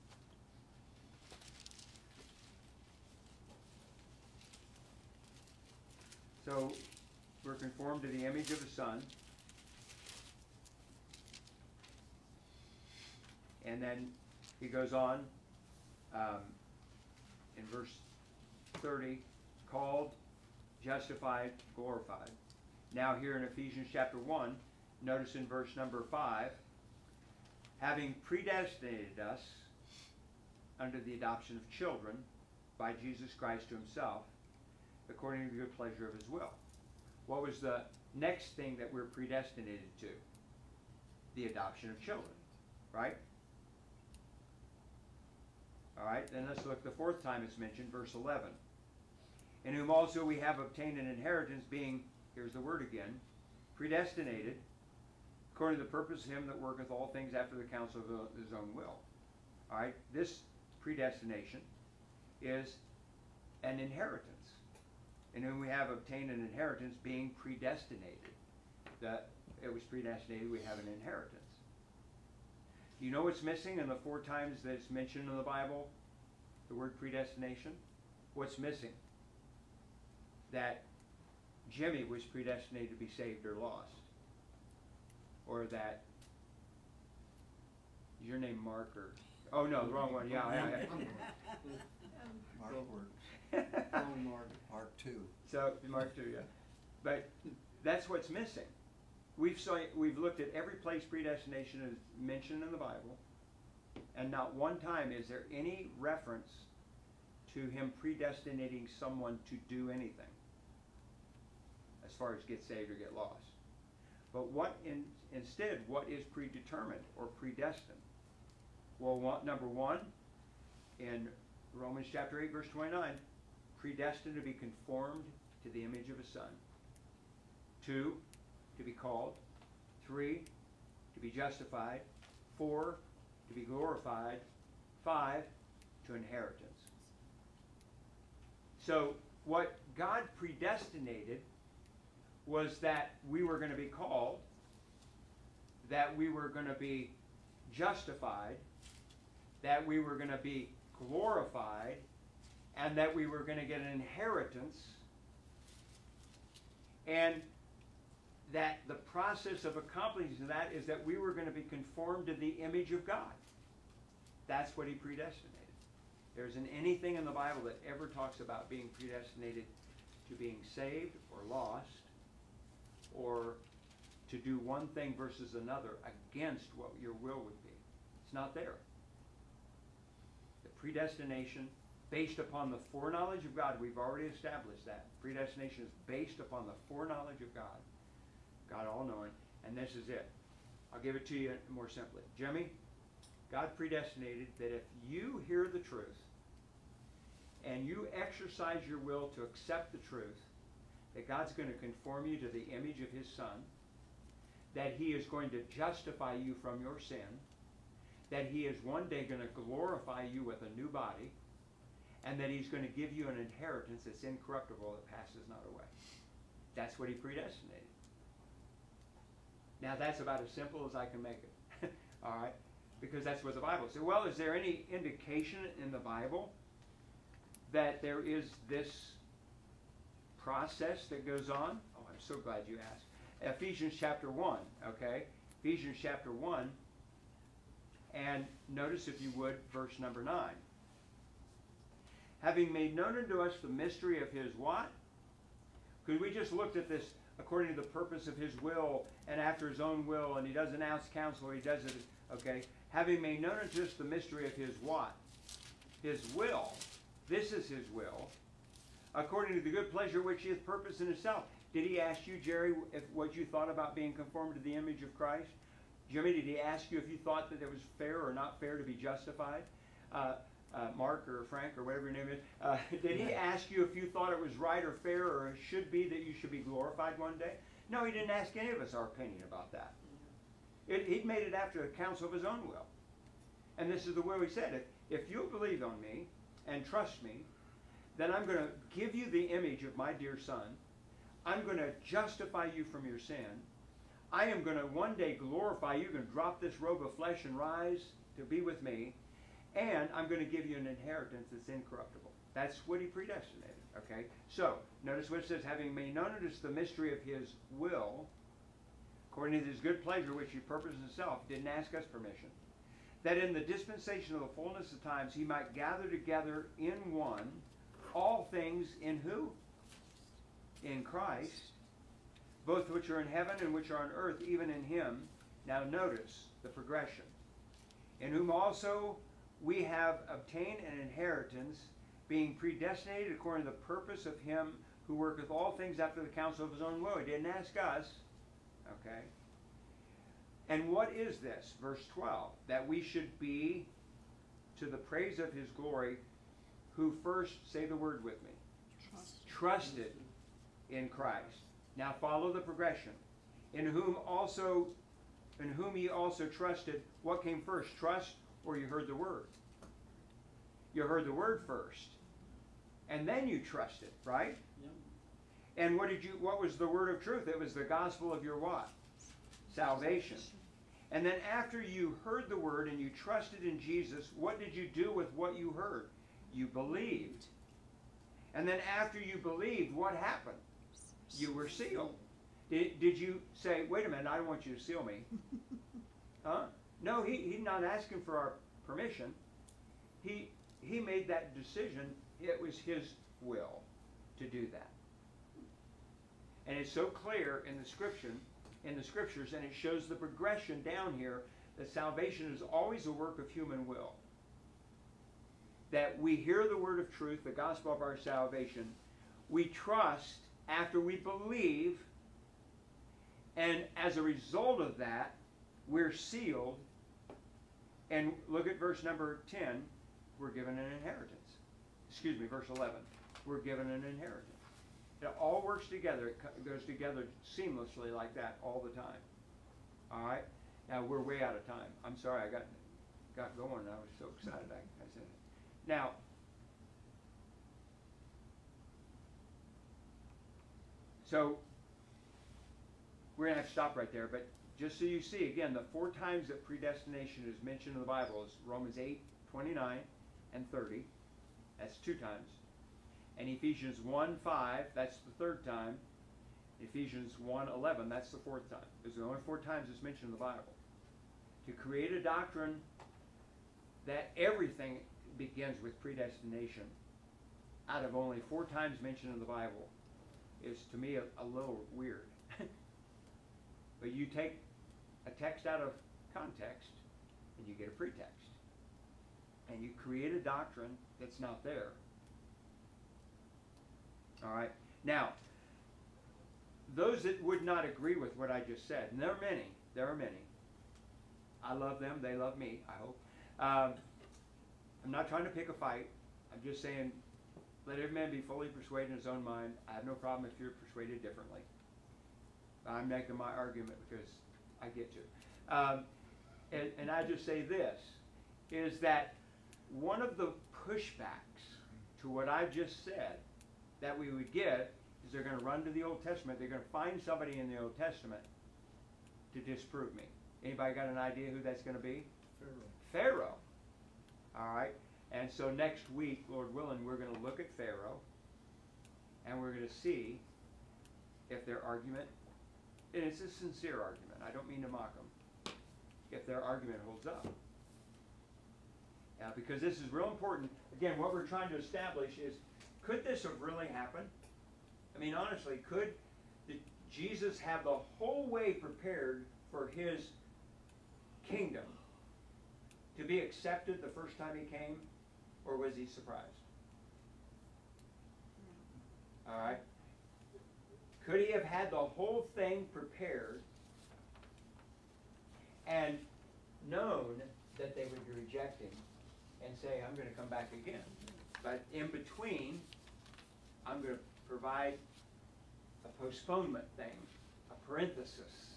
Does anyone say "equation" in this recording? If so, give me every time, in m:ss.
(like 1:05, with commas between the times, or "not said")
not said.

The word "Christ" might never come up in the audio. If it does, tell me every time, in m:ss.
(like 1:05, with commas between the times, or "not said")
0:33, 4:25, 5:21, 5:51.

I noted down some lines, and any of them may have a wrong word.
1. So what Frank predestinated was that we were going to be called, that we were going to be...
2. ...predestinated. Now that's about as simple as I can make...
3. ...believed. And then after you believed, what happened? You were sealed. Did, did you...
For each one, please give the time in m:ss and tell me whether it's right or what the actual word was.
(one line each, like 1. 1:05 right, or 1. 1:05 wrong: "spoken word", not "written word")
1. 2:18 wrong: "God", not "Frank"
2. 3:37 right
3. 6:16 right.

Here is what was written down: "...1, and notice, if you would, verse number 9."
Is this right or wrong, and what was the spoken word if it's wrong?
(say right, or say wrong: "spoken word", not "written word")
right.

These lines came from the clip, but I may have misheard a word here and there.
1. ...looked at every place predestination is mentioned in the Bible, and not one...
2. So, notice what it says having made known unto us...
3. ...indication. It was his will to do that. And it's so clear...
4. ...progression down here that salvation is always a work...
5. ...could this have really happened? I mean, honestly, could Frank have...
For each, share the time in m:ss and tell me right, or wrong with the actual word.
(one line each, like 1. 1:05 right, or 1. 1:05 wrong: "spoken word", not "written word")
1. 1:40 right
2. 5:04 right
3. 6:31 wrong: "decision", not "indication"
4. 6:40 right
5. 9:03 wrong: "Jesus", not "Frank".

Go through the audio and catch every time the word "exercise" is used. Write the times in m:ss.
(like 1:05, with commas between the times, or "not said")
3:18.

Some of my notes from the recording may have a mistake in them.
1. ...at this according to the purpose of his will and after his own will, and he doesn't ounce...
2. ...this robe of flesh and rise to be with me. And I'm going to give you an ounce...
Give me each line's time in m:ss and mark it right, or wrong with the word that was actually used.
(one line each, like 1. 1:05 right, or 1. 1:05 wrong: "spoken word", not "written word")
1. 4:06 right
2. 4:56 wrong: "inheritance", not "ounce".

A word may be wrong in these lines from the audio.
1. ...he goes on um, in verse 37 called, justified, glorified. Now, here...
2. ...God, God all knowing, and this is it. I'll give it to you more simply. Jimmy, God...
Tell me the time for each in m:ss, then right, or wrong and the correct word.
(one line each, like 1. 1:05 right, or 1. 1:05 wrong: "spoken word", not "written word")
1. 0:14 wrong: "30", not "37"
2. 3:07 right.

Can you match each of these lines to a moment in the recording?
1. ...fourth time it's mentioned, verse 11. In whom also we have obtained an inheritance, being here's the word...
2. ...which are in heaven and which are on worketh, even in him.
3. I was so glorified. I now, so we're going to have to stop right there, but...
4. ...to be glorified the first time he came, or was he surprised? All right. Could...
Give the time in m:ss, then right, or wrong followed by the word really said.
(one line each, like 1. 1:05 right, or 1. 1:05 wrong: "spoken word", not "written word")
1. 0:46 right
2. 5:22 wrong: "earth", not "worketh"
3. 7:13 wrong: "excited", not "glorified"
4. 9:13 wrong: "accepted", not "glorified".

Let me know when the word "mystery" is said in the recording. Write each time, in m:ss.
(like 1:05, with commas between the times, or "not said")
4:03, 4:14, 5:06.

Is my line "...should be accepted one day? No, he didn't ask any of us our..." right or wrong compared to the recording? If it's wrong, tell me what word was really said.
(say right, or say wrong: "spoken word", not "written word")
wrong: "glorified", not "accepted".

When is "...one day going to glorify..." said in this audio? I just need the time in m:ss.
3:28.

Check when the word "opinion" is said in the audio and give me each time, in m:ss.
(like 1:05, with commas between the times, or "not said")
4:39.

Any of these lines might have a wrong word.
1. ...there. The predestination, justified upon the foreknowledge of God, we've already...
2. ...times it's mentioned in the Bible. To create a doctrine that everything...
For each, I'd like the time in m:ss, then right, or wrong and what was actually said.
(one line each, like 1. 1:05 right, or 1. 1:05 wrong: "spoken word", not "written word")
1. 2:58 wrong: "based", not "justified"
2. 7:39 right.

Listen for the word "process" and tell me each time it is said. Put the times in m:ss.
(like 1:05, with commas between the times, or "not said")
2:38, 3:50.